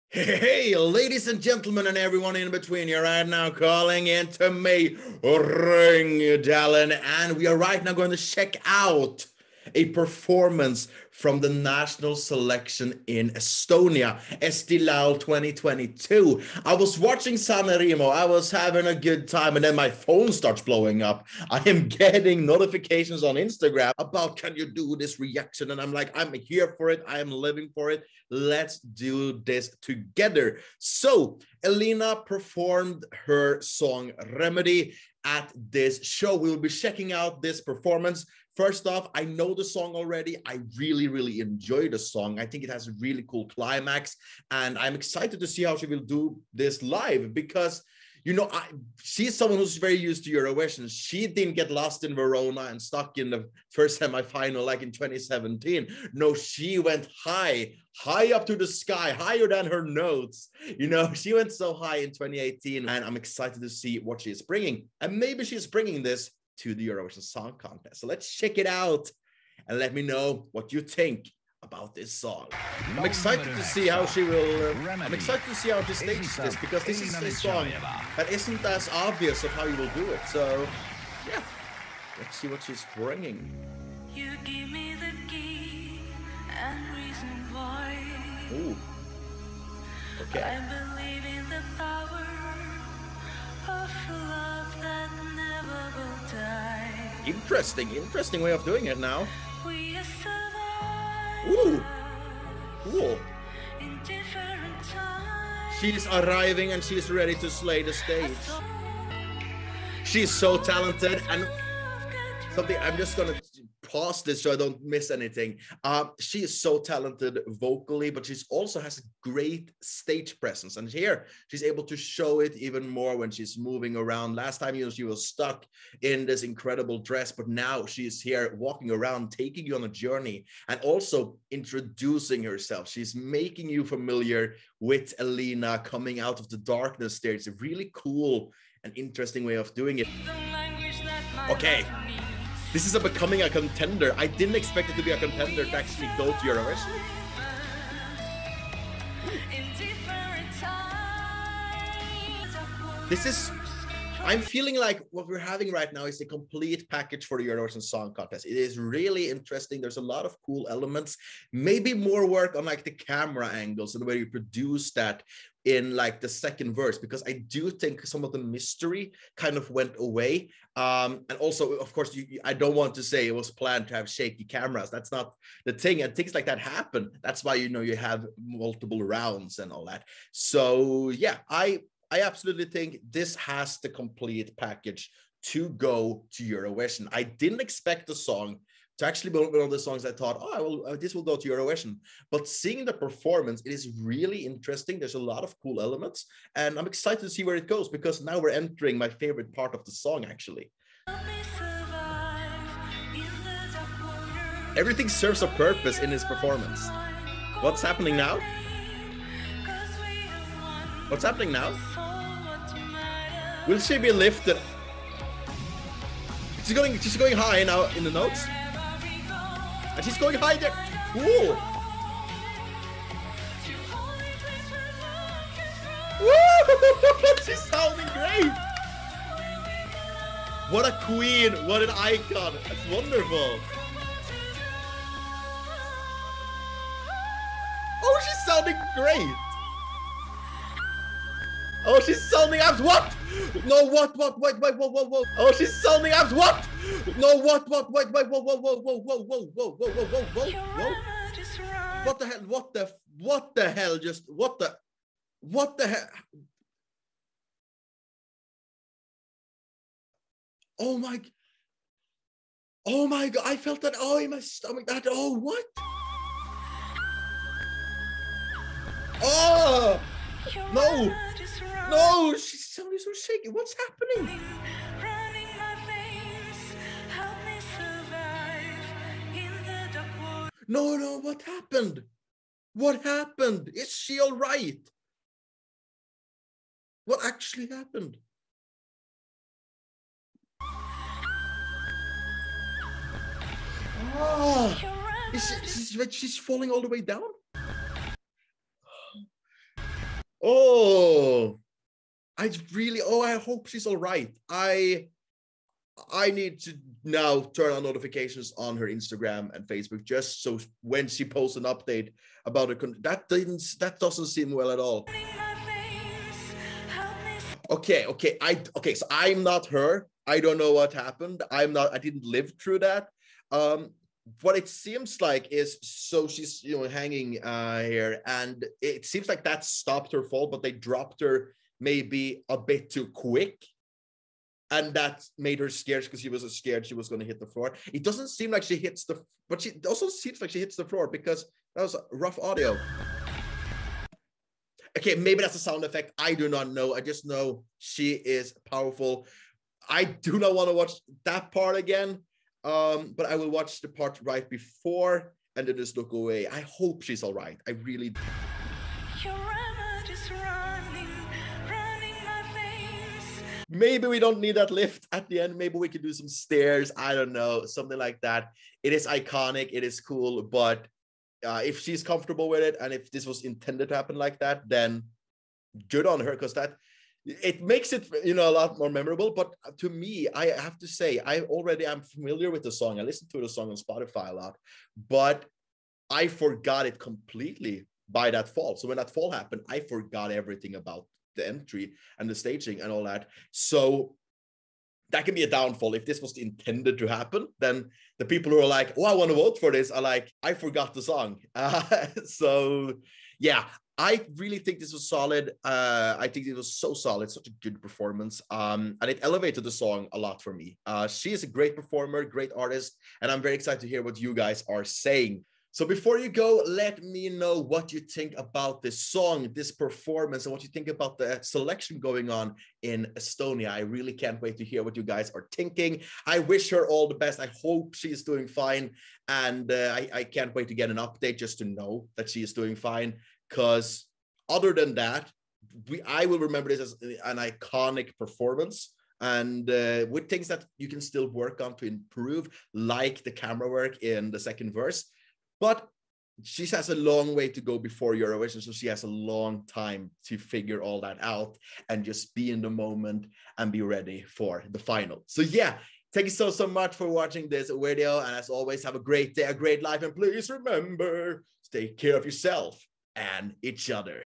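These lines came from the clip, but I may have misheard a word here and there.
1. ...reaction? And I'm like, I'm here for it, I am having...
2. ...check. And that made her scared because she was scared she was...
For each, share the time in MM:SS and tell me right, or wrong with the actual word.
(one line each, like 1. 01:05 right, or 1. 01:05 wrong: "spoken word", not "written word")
1. 00:25 wrong: "living", not "having"
2. 05:33 wrong: "quick", not "check".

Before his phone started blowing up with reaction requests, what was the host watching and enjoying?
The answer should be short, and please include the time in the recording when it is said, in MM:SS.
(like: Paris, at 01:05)
Remo, at 00:17.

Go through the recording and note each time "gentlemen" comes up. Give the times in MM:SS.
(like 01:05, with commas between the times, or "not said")
00:01.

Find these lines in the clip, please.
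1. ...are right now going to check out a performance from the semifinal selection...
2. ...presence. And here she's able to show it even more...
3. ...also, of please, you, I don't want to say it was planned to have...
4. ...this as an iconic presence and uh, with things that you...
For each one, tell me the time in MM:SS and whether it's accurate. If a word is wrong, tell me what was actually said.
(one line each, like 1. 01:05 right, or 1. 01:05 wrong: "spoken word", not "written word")
1. 00:07 wrong: "national", not "semifinal"
2. 02:00 right
3. 02:51 wrong: "course", not "please"
4. 07:16 wrong: "performance", not "presence".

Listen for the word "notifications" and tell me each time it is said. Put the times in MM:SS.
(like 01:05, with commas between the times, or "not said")
00:22, 05:07.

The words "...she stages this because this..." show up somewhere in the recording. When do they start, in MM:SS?
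01:15.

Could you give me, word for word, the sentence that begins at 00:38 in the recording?
First off, I know the song already.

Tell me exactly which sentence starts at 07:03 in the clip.
I really can't wait to hear what you guys are thinking.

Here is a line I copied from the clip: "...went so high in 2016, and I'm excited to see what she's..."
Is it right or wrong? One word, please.
wrong.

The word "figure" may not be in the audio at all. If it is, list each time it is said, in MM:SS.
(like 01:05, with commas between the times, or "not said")
07:30.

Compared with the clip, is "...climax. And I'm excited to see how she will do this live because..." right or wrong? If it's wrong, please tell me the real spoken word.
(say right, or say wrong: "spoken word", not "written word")
right.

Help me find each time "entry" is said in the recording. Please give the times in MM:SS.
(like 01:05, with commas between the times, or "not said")
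06:31.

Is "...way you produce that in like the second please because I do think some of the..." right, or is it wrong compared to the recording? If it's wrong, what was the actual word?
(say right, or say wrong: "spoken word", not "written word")
wrong: "verse", not "please".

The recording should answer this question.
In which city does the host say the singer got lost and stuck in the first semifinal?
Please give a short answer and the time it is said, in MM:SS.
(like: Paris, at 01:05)
Verona, at 00:52.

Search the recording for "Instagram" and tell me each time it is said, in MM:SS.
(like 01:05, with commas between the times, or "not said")
00:23, 05:08.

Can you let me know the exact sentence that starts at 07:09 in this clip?
And uh, I, I can't wait to get an update just to know that she is doing fine.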